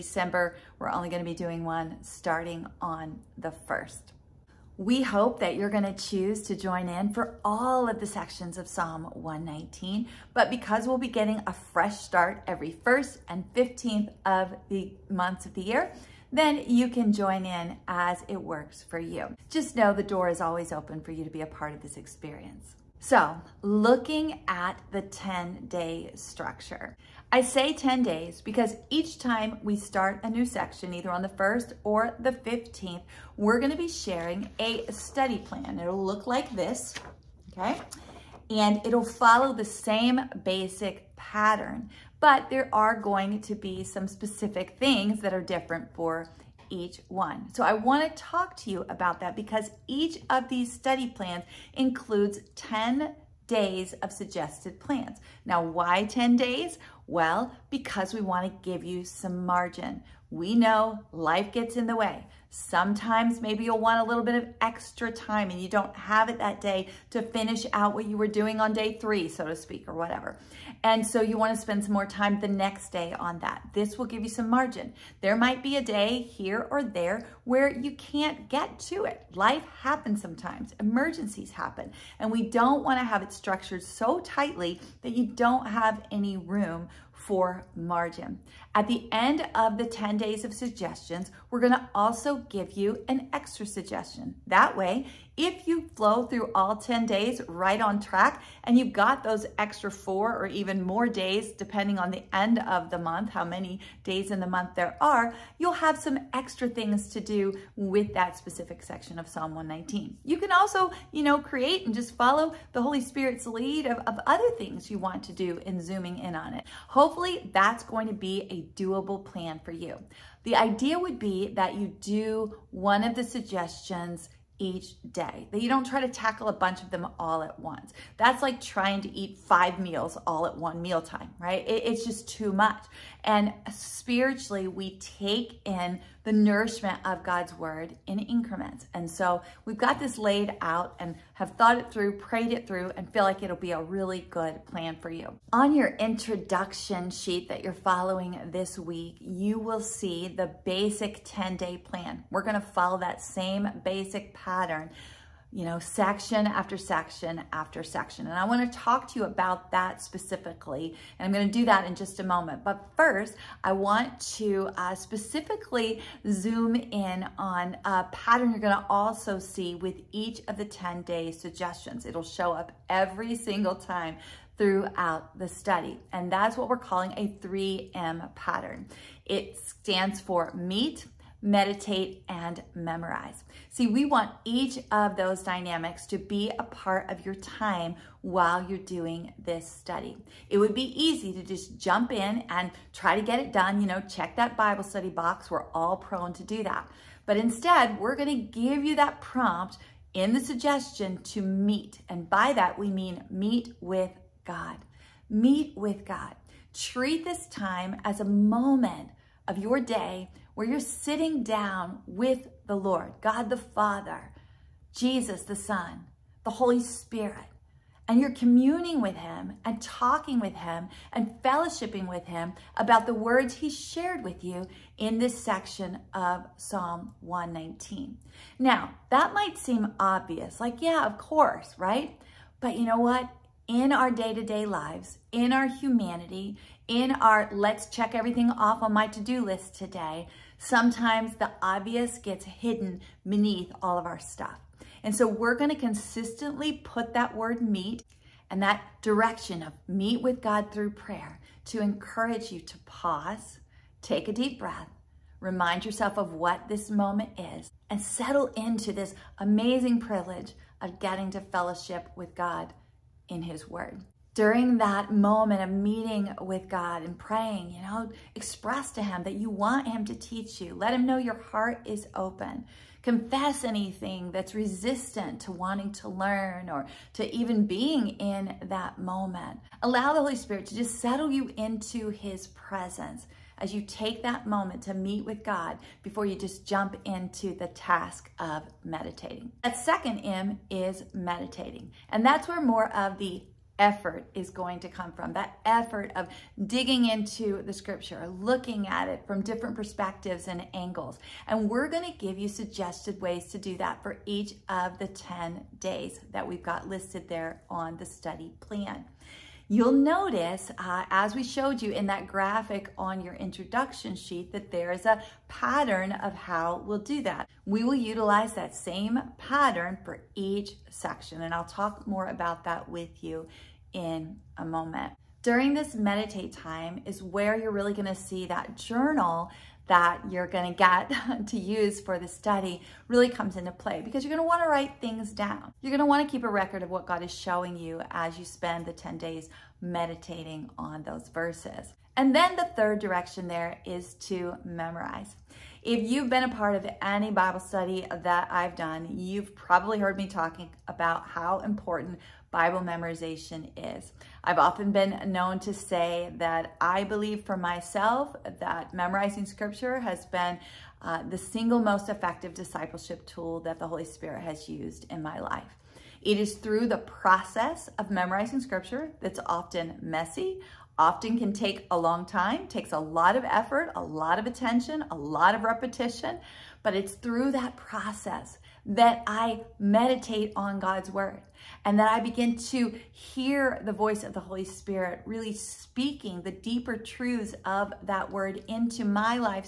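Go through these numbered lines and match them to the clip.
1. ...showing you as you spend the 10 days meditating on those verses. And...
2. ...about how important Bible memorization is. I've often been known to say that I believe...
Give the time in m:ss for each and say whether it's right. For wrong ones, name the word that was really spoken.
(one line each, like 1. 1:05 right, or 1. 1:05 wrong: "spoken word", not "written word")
1. 5:37 right
2. 5:50 right.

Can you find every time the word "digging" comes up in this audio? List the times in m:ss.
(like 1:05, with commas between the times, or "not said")
4:56.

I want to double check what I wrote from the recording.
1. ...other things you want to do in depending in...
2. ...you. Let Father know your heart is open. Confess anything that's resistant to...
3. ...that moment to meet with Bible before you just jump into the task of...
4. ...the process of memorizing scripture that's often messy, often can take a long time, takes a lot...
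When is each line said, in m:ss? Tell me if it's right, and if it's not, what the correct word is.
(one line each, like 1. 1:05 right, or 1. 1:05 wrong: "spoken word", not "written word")
1. 1:54 wrong: "zooming", not "depending"
2. 4:30 wrong: "Him", not "Father"
3. 4:44 wrong: "God", not "Bible"
4. 6:06 right.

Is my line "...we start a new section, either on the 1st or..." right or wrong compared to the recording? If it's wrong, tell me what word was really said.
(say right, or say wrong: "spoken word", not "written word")
right.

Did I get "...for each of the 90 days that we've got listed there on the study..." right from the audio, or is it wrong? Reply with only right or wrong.
wrong.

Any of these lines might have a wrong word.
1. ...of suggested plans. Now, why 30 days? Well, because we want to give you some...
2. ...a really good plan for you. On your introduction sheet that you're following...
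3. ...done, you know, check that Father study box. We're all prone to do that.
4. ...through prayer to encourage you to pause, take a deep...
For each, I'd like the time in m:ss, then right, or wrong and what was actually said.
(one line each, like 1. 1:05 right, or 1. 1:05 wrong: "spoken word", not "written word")
1. 0:54 wrong: "10", not "30"
2. 2:23 right
3. 3:13 wrong: "Bible", not "Father"
4. 4:10 right.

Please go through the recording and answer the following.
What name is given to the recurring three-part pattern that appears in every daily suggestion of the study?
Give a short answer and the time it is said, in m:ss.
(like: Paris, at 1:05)
3M pattern, at 2:57.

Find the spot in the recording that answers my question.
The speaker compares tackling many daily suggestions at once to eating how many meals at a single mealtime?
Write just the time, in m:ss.
2:09.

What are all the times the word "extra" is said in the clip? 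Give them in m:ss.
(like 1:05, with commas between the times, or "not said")
1:04, 1:33, 1:39, 1:46.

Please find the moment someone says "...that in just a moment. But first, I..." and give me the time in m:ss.
2:41.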